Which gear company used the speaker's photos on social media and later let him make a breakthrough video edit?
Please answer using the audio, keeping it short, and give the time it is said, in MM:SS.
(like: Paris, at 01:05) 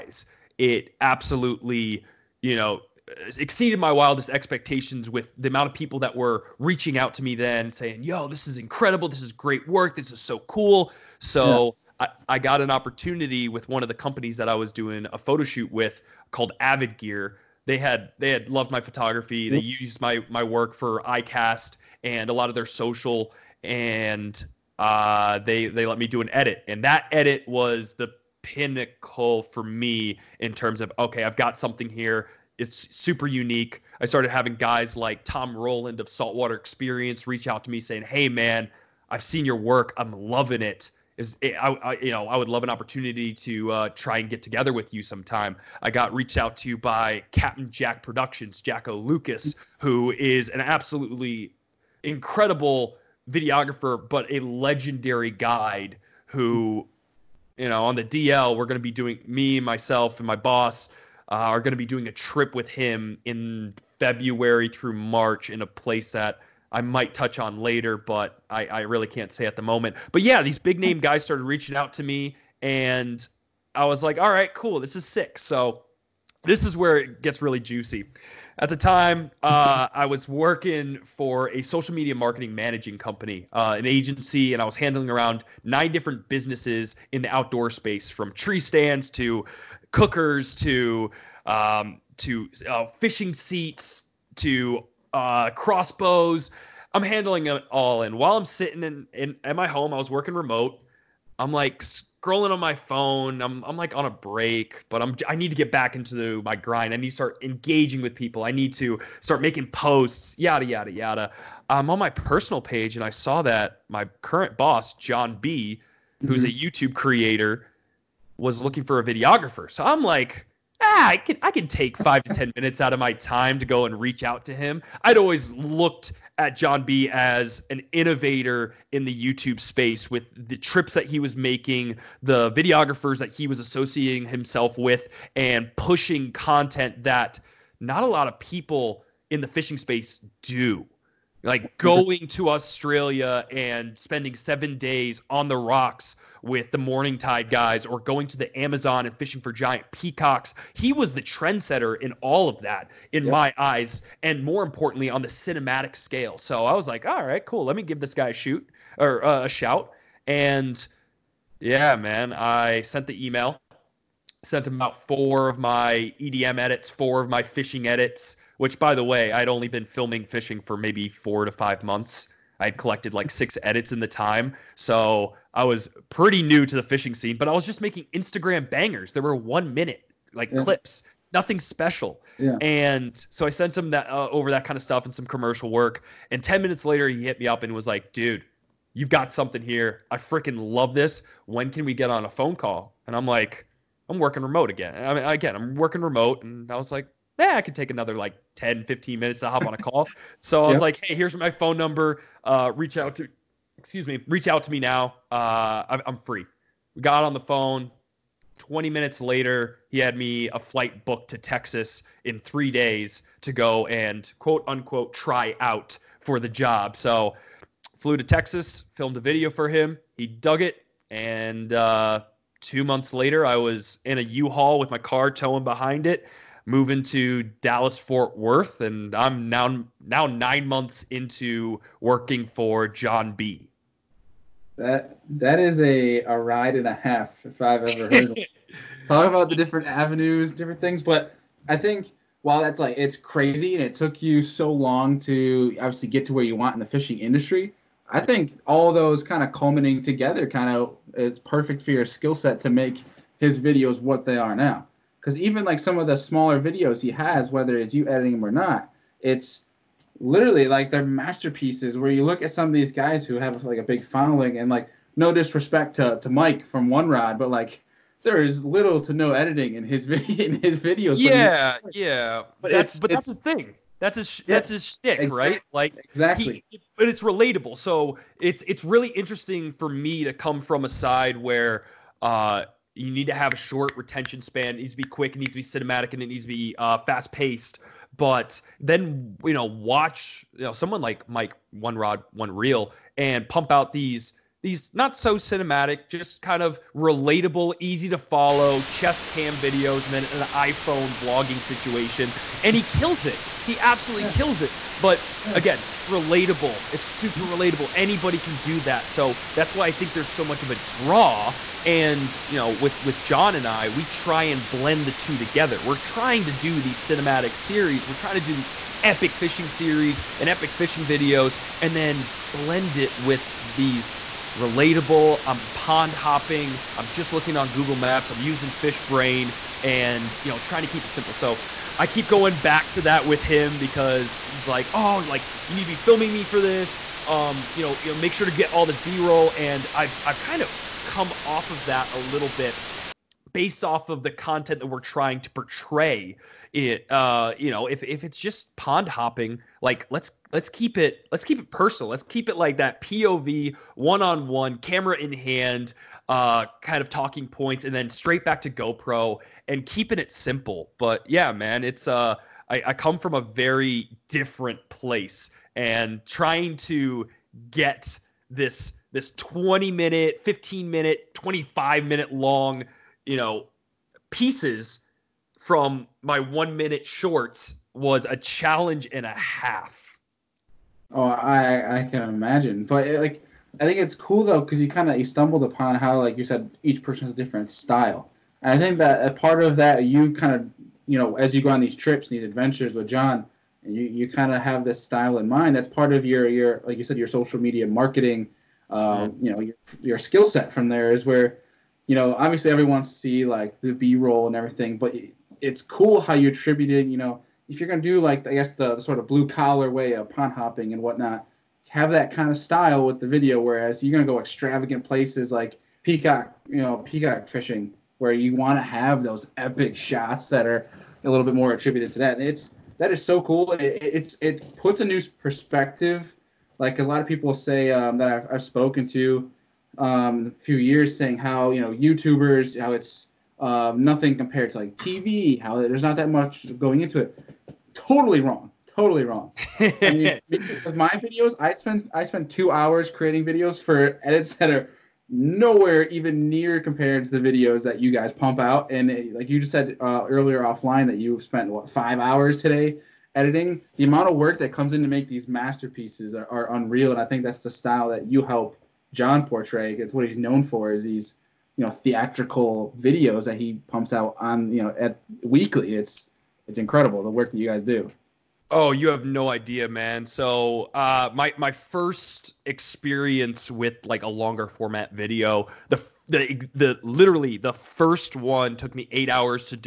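Avid Gear, at 00:16.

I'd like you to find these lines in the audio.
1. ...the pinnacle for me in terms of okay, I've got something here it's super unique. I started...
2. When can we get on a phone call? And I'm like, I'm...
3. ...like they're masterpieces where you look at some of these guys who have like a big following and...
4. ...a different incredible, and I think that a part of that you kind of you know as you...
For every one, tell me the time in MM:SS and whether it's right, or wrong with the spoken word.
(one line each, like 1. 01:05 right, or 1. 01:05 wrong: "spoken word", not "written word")
1. 00:27 right
2. 03:11 right
3. 04:20 right
4. 06:27 wrong: "style", not "incredible".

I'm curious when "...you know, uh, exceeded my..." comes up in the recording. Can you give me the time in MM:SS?
00:02.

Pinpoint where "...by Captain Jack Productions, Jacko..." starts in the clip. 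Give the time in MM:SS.
00:46.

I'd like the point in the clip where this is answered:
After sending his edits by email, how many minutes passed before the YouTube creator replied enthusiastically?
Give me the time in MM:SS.
03:06.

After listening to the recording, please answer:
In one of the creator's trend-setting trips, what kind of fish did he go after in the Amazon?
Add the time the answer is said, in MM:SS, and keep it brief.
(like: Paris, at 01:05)
giant peacocks, at 02:29.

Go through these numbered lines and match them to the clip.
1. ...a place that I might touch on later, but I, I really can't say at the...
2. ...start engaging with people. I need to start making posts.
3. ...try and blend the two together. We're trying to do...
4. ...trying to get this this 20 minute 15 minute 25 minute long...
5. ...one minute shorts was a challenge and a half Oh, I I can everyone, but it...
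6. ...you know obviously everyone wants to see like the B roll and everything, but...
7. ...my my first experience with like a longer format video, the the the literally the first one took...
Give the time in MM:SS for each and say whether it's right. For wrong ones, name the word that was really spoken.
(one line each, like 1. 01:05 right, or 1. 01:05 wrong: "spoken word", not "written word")
1. 01:05 right
2. 01:47 right
3. 05:14 right
4. 06:06 right
5. 06:16 wrong: "imagine", not "everyone"
6. 06:42 right
7. 07:51 right.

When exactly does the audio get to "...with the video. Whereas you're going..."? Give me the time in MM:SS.
06:53.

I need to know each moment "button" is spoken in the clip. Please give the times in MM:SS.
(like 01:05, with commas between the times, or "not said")
not said.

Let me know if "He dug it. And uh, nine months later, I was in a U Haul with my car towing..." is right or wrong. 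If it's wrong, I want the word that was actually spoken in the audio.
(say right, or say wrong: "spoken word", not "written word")
wrong: "two", not "nine".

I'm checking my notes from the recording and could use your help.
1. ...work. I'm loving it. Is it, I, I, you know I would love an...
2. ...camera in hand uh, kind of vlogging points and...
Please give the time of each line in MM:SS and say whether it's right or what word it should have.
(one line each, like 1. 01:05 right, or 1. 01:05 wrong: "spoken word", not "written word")
1. 00:39 right
2. 05:54 wrong: "talking", not "vlogging".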